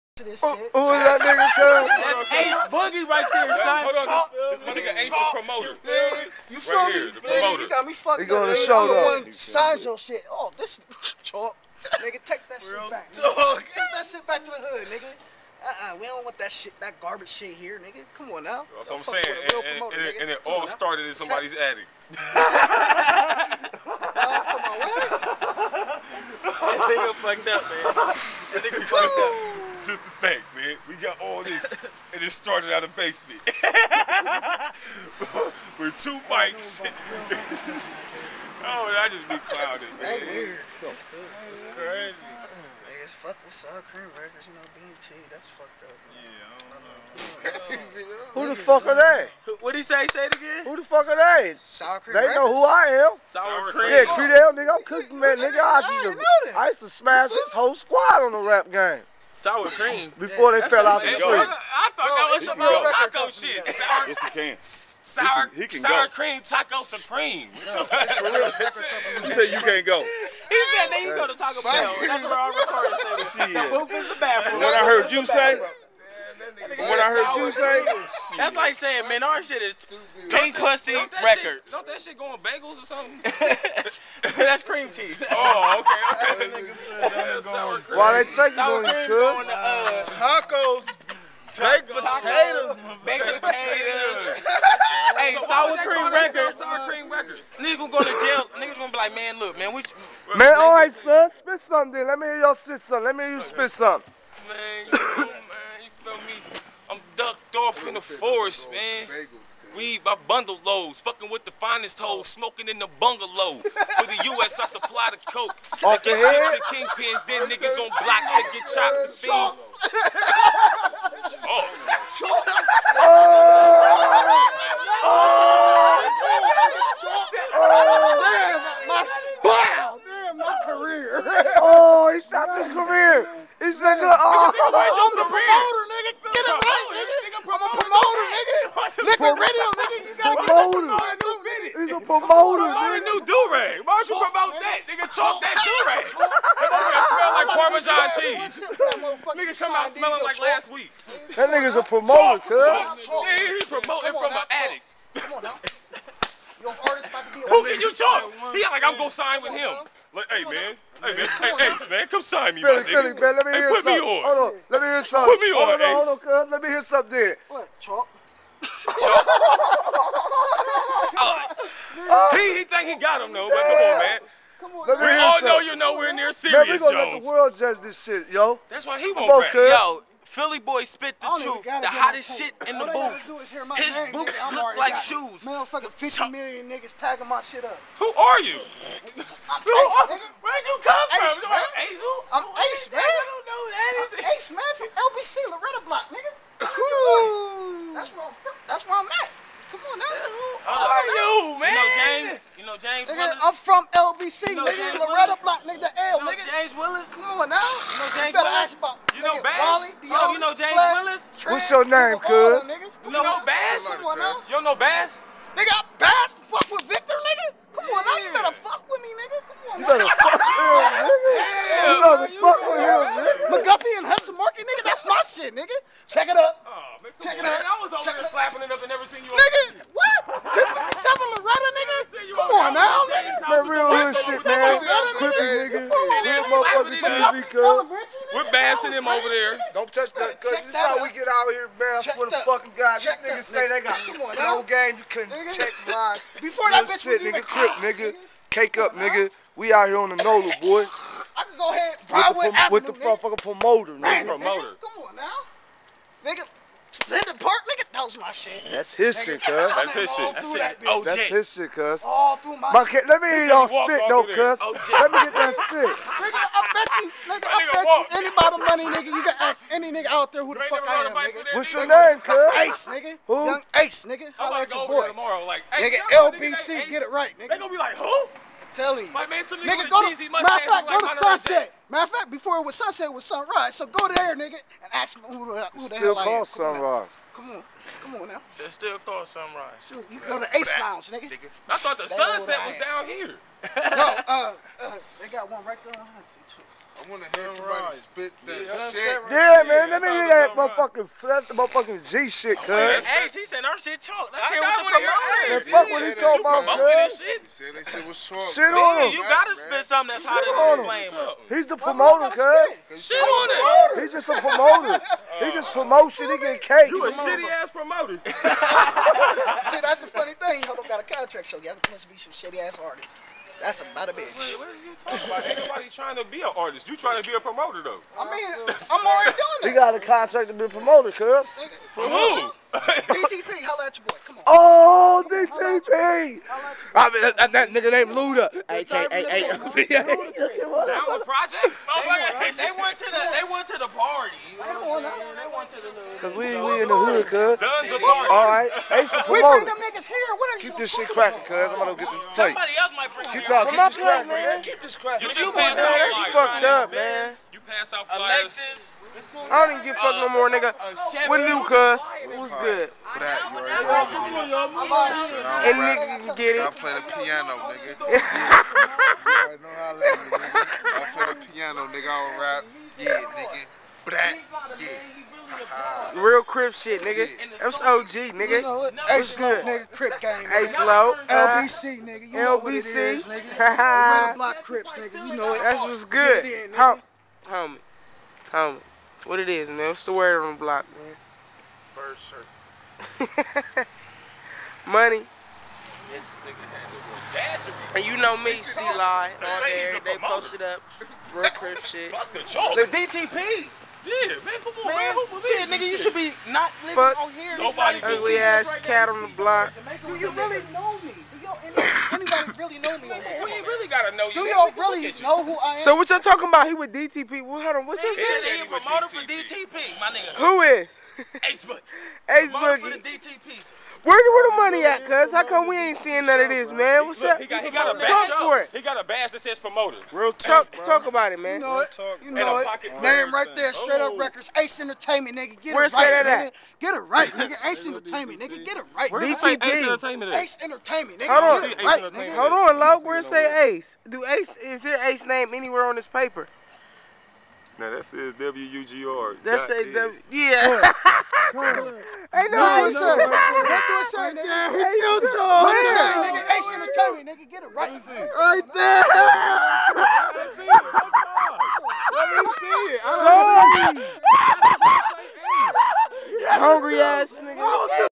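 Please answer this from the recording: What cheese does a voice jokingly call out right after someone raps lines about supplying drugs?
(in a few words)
Parmesan cheese.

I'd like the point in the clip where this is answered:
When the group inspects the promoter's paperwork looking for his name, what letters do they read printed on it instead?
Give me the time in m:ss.
7:28.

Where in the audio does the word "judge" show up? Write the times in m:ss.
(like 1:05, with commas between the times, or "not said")
2:57.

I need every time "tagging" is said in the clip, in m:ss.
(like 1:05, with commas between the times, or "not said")
3:06.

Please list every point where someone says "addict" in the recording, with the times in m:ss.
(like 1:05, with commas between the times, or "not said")
2:34.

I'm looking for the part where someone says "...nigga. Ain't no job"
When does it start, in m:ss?
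7:34.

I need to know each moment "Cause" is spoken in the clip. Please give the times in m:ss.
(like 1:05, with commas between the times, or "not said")
5:46.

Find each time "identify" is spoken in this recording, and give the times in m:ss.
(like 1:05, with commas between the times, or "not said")
not said.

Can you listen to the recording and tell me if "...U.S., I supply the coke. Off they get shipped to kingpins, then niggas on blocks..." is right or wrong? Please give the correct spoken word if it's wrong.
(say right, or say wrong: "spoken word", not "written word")
right.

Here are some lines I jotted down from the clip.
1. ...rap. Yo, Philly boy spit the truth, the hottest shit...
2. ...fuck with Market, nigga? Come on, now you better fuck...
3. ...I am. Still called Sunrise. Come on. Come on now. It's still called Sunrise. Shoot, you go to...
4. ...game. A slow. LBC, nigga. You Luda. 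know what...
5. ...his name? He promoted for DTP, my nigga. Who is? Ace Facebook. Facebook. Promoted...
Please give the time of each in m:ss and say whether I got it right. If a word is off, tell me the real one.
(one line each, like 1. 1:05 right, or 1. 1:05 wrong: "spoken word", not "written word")
1. 2:59 right
2. 3:36 wrong: "Victor", not "Market"
3. 4:45 right
4. 6:20 wrong: "LBC", not "Luda"
5. 6:58 right.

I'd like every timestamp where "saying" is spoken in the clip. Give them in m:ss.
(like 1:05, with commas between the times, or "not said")
0:19, 1:18.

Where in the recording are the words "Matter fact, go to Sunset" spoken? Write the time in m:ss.
4:40.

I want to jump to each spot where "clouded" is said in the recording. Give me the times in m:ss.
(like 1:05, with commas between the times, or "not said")
0:39.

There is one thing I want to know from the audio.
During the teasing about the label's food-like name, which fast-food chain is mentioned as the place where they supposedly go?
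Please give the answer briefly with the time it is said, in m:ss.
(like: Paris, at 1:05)
Taco Bell, at 1:11.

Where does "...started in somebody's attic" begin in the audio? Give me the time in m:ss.
0:20.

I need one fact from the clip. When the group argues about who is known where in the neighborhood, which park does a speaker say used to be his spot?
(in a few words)
Linden Park.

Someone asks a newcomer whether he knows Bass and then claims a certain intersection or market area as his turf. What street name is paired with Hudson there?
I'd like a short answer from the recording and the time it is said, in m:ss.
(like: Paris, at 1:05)
McGuffey, at 3:43.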